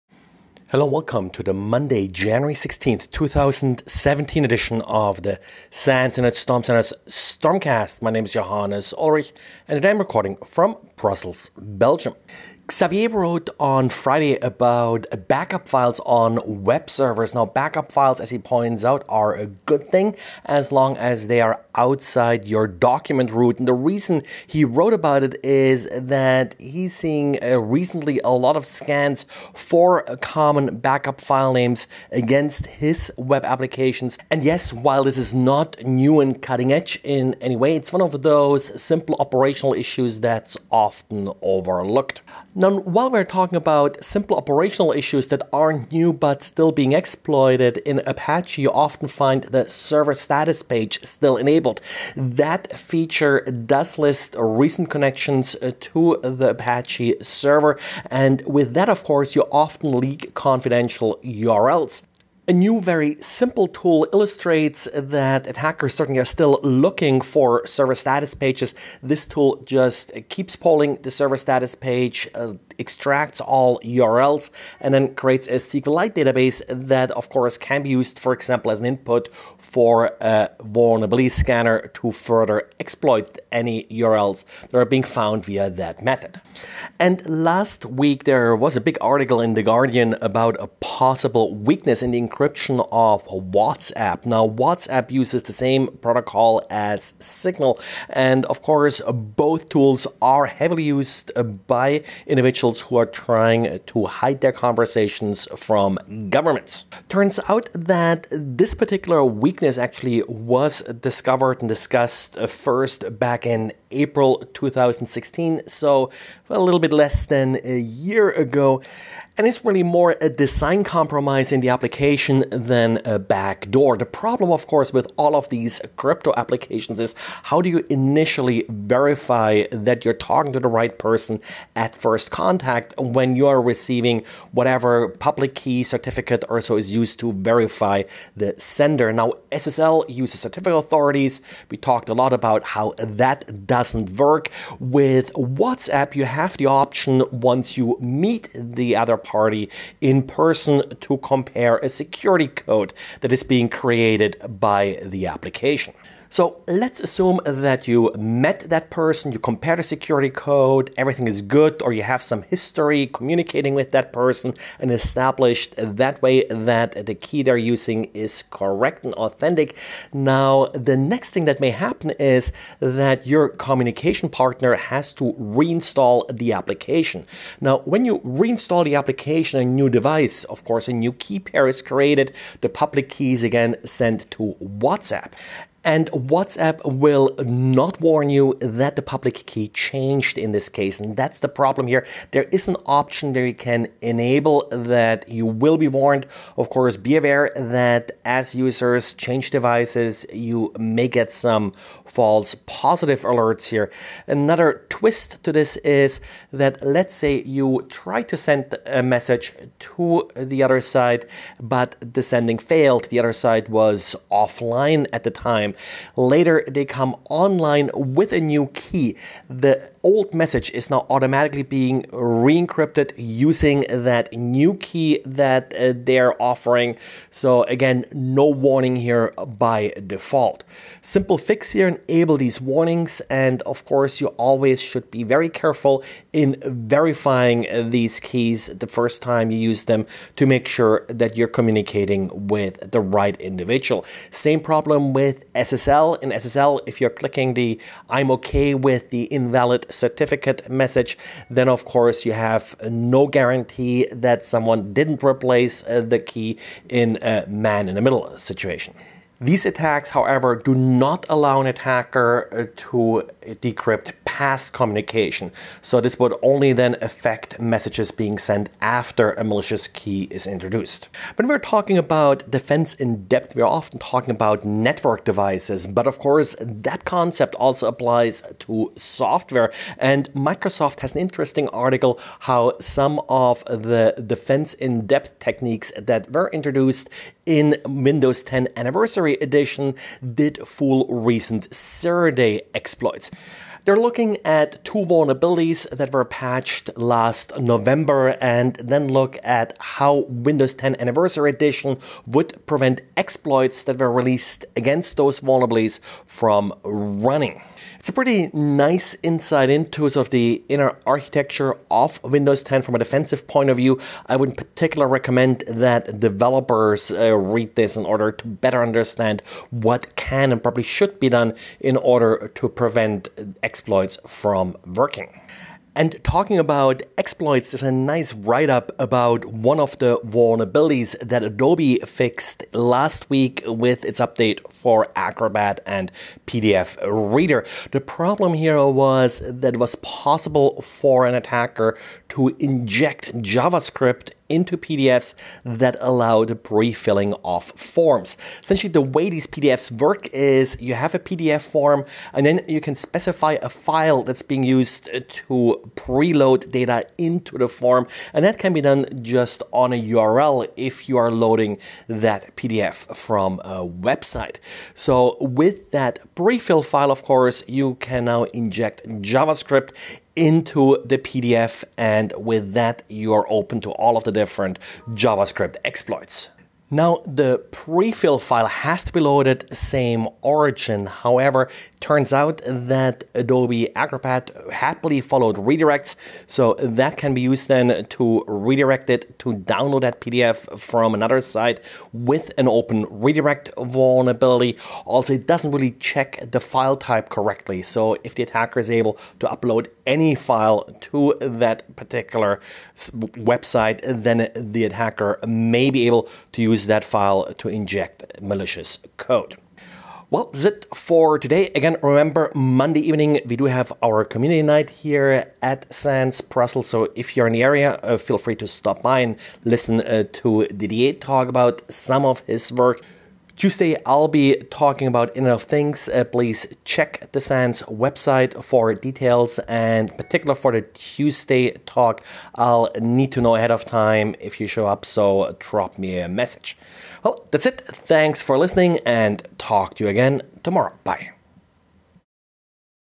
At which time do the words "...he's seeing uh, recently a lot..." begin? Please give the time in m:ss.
0:26.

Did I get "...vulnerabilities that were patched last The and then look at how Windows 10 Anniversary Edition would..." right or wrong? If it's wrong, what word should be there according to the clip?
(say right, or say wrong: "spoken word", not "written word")
wrong: "November", not "The".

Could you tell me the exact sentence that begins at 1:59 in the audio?
And it's really more a design compromise in the application than a backdoor.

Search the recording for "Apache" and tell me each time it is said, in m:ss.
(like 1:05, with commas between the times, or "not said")
0:48, 0:56.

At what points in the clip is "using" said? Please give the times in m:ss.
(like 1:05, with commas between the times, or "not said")
2:47, 3:43.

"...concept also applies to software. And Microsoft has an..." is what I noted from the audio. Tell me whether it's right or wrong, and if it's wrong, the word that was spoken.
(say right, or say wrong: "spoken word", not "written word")
right.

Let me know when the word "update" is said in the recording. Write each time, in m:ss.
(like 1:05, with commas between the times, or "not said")
5:34.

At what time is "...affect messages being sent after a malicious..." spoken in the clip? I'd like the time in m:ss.
4:26.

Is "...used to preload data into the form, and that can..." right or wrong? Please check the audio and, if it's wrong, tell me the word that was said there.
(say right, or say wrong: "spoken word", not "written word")
right.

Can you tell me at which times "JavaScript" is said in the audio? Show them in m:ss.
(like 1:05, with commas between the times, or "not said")
5:43, 6:09, 6:15.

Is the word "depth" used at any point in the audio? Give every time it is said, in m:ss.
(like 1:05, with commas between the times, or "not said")
4:33, 4:45.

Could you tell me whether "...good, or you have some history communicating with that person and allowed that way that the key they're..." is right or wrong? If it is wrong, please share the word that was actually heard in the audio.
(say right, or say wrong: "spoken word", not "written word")
wrong: "established", not "allowed".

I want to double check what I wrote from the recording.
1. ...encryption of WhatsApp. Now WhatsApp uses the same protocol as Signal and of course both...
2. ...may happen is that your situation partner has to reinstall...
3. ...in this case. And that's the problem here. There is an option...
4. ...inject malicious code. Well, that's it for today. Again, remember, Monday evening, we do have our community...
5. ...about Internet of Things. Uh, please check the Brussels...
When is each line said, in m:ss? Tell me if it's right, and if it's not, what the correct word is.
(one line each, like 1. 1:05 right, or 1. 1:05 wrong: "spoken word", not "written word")
1. 1:32 right
2. 2:51 wrong: "communication", not "situation"
3. 3:10 right
4. 6:47 right
5. 7:05 wrong: "SANS", not "Brussels".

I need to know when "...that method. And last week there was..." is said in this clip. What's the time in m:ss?
1:25.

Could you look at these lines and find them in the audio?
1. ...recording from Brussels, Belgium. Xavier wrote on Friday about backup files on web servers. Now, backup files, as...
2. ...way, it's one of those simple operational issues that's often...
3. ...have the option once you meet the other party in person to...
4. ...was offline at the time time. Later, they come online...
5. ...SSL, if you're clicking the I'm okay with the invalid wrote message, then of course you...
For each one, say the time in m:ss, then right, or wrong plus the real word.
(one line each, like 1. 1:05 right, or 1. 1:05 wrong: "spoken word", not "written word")
1. 0:09 right
2. 0:37 right
3. 2:26 right
4. 3:33 right
5. 4:06 wrong: "certificate", not "wrote".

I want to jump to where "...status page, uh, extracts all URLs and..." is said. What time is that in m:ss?
1:11.